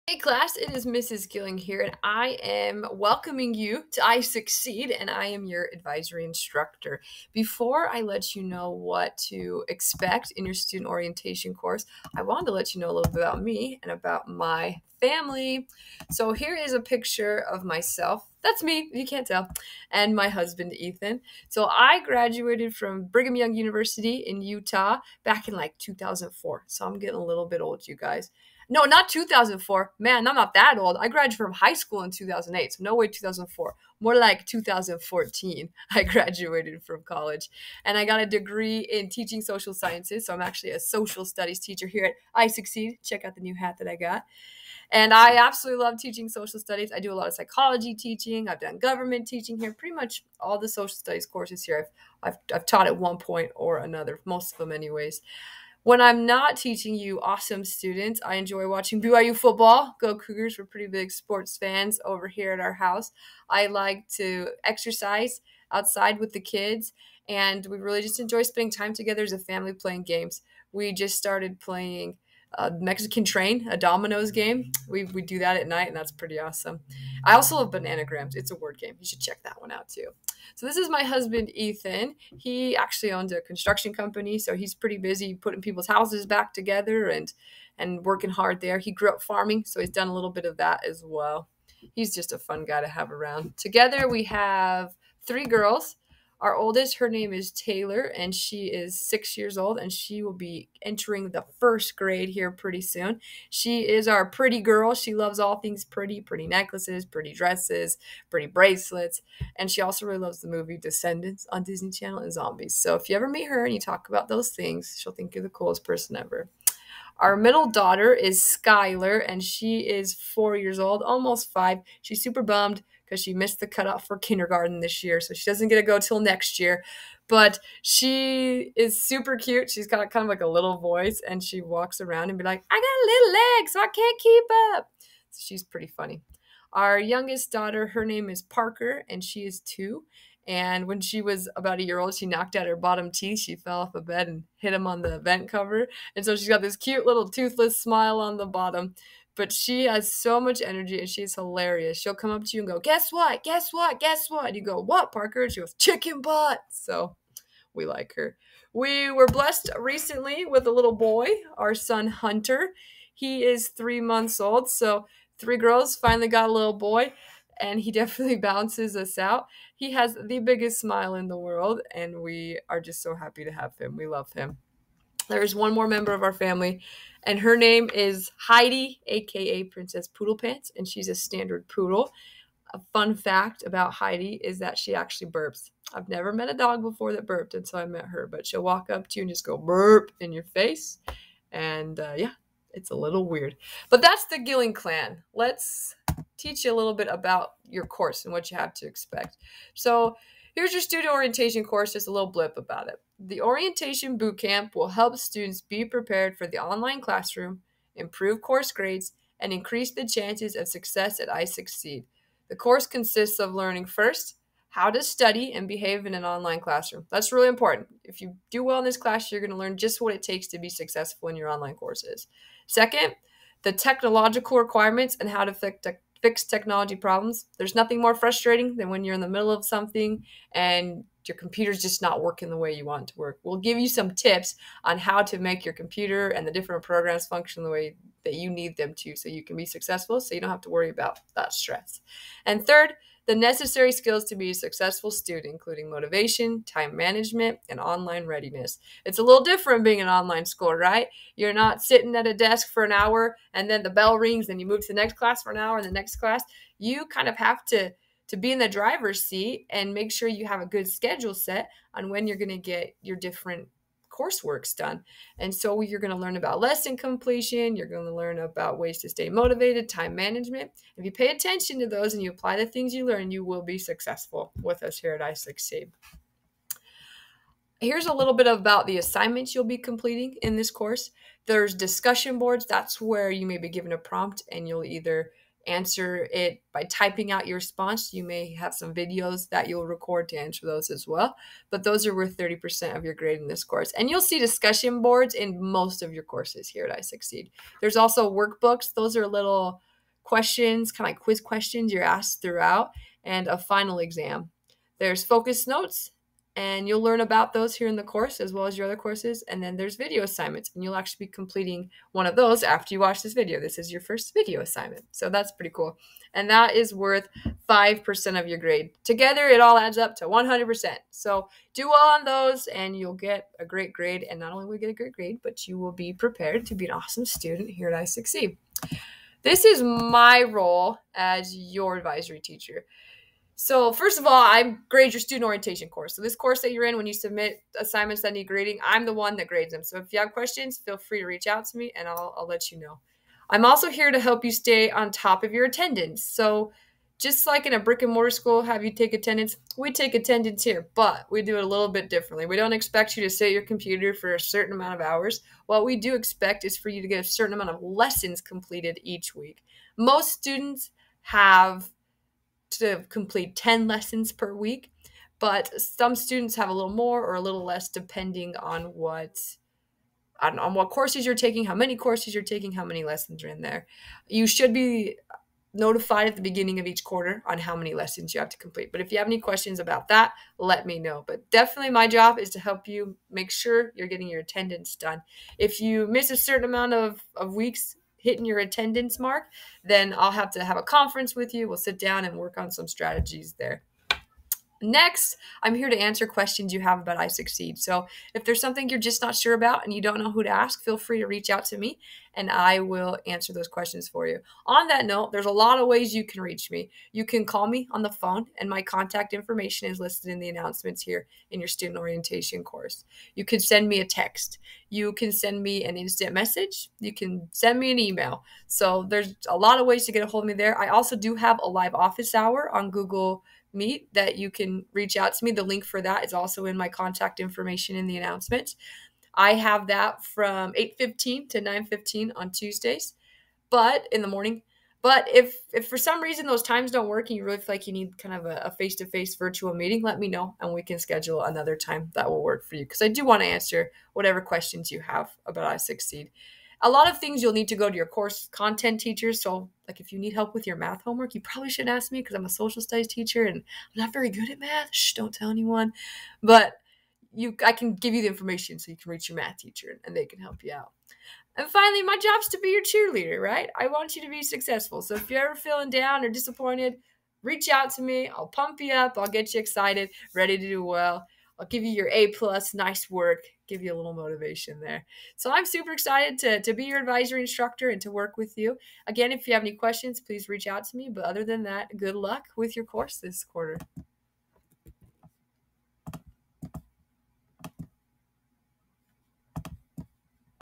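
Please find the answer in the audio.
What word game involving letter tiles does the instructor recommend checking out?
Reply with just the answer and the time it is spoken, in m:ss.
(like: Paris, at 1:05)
Bananagrams, at 1:17.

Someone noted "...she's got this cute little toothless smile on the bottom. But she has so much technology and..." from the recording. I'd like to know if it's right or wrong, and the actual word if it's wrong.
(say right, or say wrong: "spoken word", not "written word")
wrong: "energy", not "technology".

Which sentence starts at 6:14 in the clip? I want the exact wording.
You should be notified at the beginning of each quarter on how many lessons you have to complete.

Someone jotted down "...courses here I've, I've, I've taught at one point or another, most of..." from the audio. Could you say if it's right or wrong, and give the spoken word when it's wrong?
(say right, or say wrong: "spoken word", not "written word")
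right.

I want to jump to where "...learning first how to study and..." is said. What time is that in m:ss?
3:33.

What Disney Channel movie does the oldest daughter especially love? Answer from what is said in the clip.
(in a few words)
Descendants.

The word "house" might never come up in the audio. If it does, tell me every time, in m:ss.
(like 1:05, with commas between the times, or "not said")
1:02, 1:25.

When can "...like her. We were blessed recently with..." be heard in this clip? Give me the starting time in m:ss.
2:37.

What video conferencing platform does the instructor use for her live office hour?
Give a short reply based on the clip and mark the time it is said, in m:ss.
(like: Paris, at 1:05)
Google Meet, at 7:02.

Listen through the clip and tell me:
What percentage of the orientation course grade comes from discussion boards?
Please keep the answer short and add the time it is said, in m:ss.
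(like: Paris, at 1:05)
30%, at 4:52.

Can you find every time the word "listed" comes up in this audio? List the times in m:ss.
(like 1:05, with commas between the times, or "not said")
6:49.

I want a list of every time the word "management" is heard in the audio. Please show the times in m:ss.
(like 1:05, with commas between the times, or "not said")
4:06, 4:30.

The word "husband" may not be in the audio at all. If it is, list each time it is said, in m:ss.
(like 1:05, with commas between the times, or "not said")
0:20, 1:21.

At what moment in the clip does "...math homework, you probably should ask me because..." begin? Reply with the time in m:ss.
7:30.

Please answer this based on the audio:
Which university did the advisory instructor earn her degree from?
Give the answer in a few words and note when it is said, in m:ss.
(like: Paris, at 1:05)
Brigham Young University, at 0:23.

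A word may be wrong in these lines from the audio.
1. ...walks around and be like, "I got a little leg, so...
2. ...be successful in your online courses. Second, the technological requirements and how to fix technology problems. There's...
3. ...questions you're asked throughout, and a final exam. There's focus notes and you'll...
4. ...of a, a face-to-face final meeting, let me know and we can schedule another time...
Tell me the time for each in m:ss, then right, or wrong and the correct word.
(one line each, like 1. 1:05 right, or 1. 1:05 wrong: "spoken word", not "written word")
1. 2:11 right
2. 3:40 right
3. 5:01 right
4. 7:18 wrong: "virtual", not "final".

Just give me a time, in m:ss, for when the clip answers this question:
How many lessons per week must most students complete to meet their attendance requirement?
6:03.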